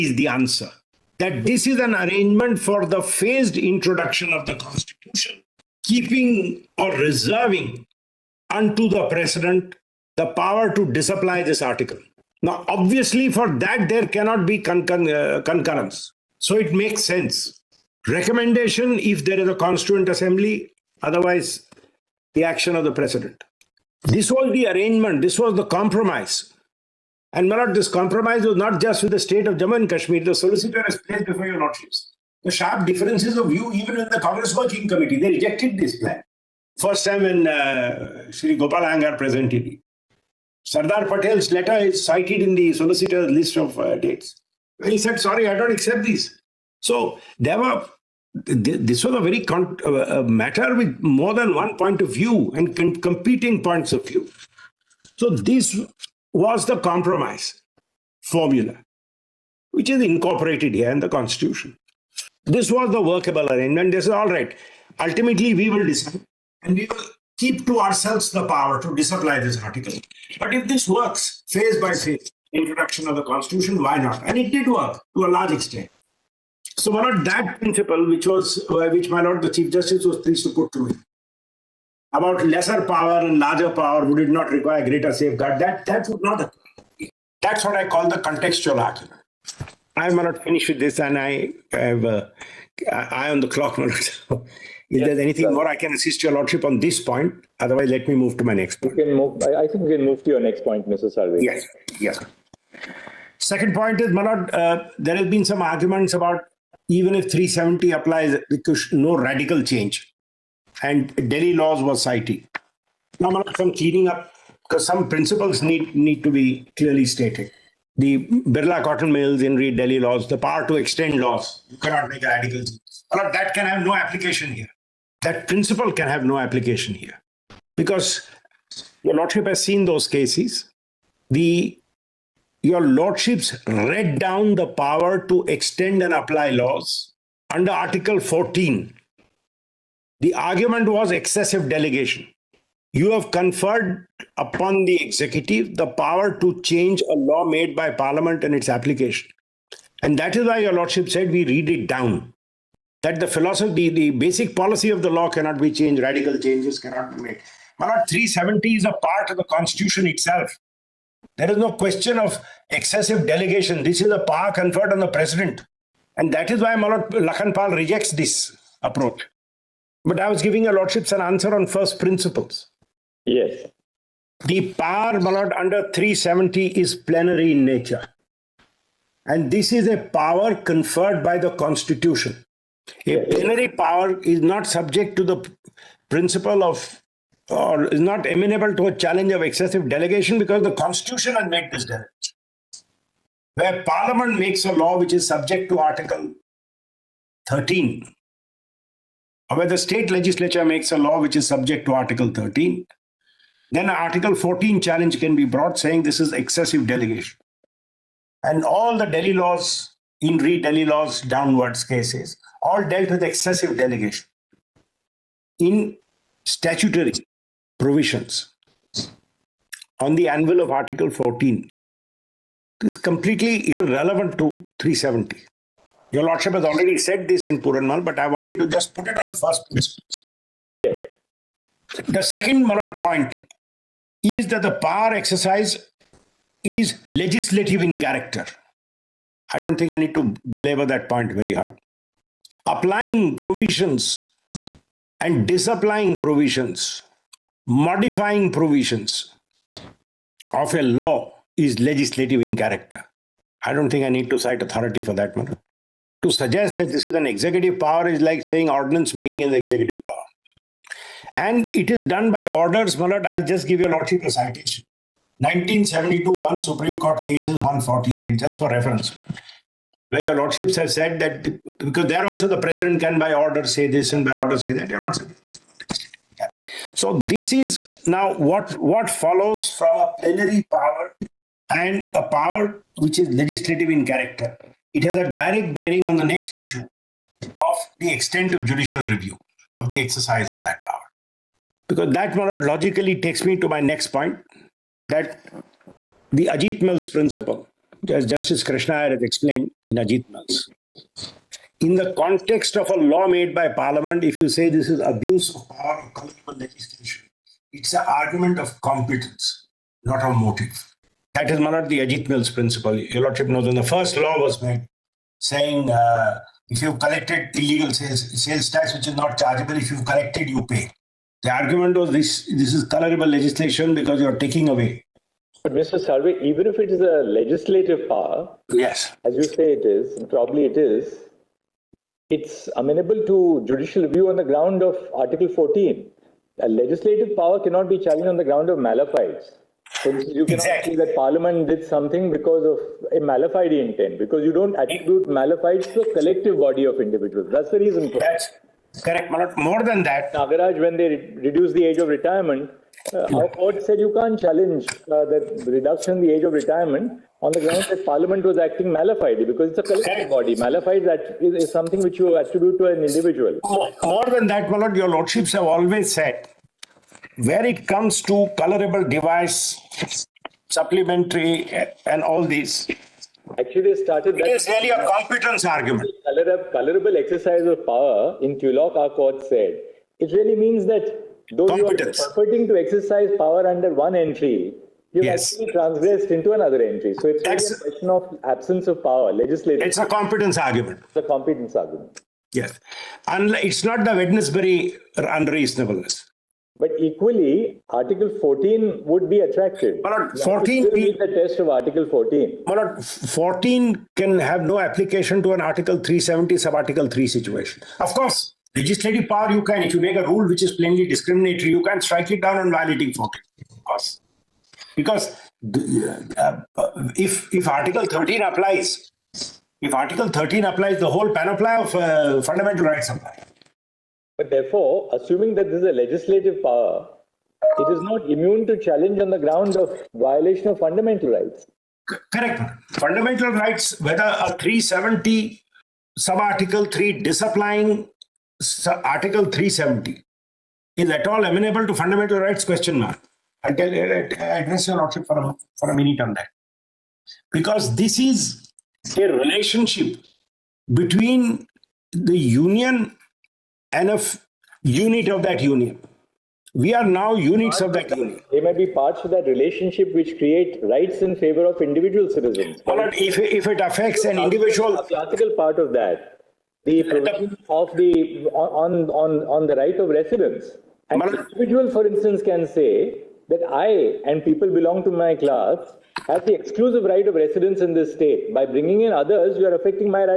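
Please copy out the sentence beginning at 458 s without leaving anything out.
They may be parts of that relationship which create rights in favor of individual citizens.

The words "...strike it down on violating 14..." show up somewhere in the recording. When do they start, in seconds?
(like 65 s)
411 s.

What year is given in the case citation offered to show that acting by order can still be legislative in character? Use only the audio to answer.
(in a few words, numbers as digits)
1972.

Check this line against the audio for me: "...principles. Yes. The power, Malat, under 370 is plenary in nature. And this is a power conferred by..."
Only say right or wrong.
right.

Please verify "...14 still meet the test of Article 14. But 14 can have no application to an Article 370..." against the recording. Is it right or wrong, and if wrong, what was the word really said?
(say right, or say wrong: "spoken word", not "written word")
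right.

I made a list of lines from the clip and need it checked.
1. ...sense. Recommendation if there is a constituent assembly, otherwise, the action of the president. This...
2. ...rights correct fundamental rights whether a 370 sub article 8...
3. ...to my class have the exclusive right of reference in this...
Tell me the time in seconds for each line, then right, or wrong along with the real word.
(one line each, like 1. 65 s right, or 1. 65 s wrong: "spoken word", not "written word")
1. 17 s right
2. 431 s wrong: "3", not "8"
3. 475 s wrong: "residence", not "reference".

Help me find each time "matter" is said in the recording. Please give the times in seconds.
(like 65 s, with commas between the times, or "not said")
50 s, 255 s.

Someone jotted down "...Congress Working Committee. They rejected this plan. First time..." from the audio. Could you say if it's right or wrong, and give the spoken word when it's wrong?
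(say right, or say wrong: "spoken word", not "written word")
right.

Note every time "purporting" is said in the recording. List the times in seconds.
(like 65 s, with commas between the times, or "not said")
382 s.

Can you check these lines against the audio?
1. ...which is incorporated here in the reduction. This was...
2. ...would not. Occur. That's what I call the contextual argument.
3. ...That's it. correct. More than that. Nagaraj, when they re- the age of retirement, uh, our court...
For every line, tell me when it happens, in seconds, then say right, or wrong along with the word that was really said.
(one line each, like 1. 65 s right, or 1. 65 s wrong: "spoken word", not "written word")
1. 59 s wrong: "constitution", not "reduction"
2. 86 s right
3. 348 s right.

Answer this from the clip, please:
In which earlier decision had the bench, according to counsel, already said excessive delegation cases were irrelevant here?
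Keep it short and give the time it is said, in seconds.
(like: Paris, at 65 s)
Puranlal, at 227 s.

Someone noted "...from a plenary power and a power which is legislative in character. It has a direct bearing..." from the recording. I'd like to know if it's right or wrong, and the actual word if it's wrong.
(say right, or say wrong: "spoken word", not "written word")
right.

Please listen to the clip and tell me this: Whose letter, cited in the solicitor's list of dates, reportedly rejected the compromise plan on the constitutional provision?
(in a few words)
Sardar Patel.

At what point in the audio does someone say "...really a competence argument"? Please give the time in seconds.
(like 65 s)
374 s.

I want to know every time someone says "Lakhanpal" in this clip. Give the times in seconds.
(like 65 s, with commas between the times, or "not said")
167 s.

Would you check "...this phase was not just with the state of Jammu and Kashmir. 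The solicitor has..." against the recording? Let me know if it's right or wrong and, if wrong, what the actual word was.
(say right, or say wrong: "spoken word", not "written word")
wrong: "compromise", not "phase".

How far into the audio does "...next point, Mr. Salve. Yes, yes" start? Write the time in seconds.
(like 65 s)
100 s.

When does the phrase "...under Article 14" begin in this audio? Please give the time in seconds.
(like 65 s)
137 s.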